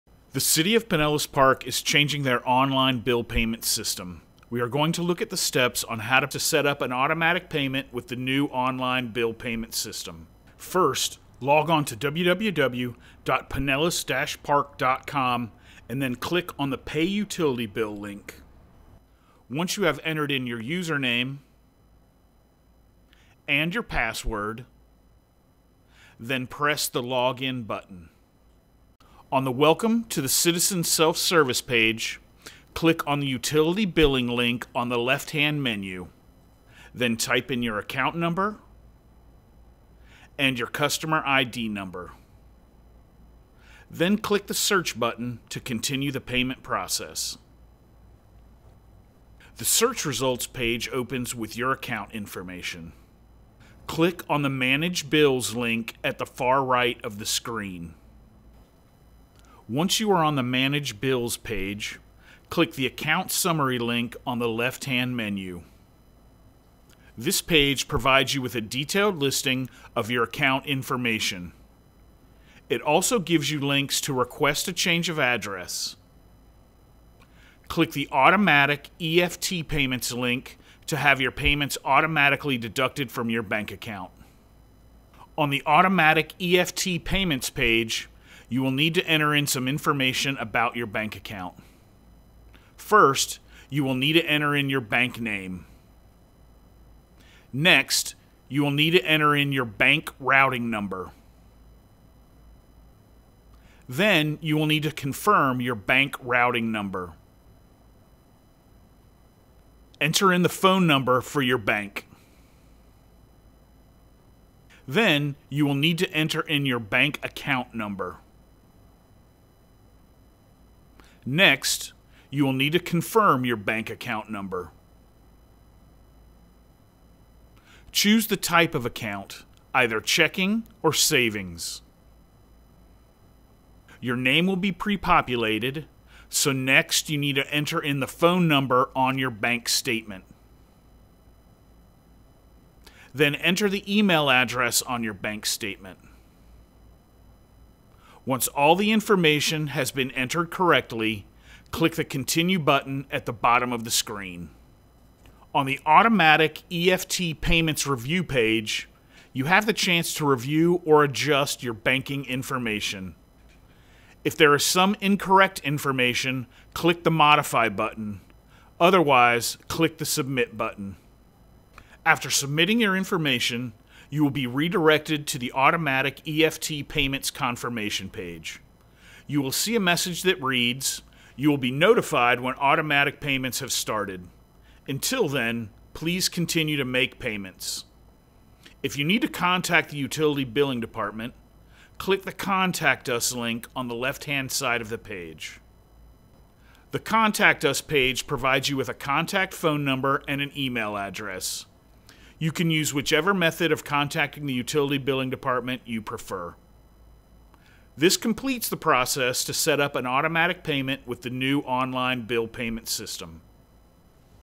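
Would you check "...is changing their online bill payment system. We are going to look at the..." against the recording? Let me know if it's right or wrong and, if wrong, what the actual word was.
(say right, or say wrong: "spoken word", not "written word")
right.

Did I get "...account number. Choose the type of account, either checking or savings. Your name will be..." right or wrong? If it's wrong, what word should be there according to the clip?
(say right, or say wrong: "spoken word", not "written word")
right.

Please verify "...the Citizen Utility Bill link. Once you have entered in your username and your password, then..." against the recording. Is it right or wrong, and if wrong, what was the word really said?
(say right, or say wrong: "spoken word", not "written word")
wrong: "Pay", not "Citizen".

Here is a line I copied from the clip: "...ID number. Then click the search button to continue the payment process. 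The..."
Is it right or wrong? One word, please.
right.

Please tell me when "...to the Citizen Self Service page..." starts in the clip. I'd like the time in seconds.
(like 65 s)
30 s.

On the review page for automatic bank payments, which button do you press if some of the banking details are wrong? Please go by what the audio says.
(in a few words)
Modify.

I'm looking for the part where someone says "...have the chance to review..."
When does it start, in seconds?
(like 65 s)
159 s.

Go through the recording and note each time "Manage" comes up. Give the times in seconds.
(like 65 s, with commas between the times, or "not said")
54 s, 60 s.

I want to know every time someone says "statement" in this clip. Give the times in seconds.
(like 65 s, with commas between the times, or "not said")
139 s, 145 s.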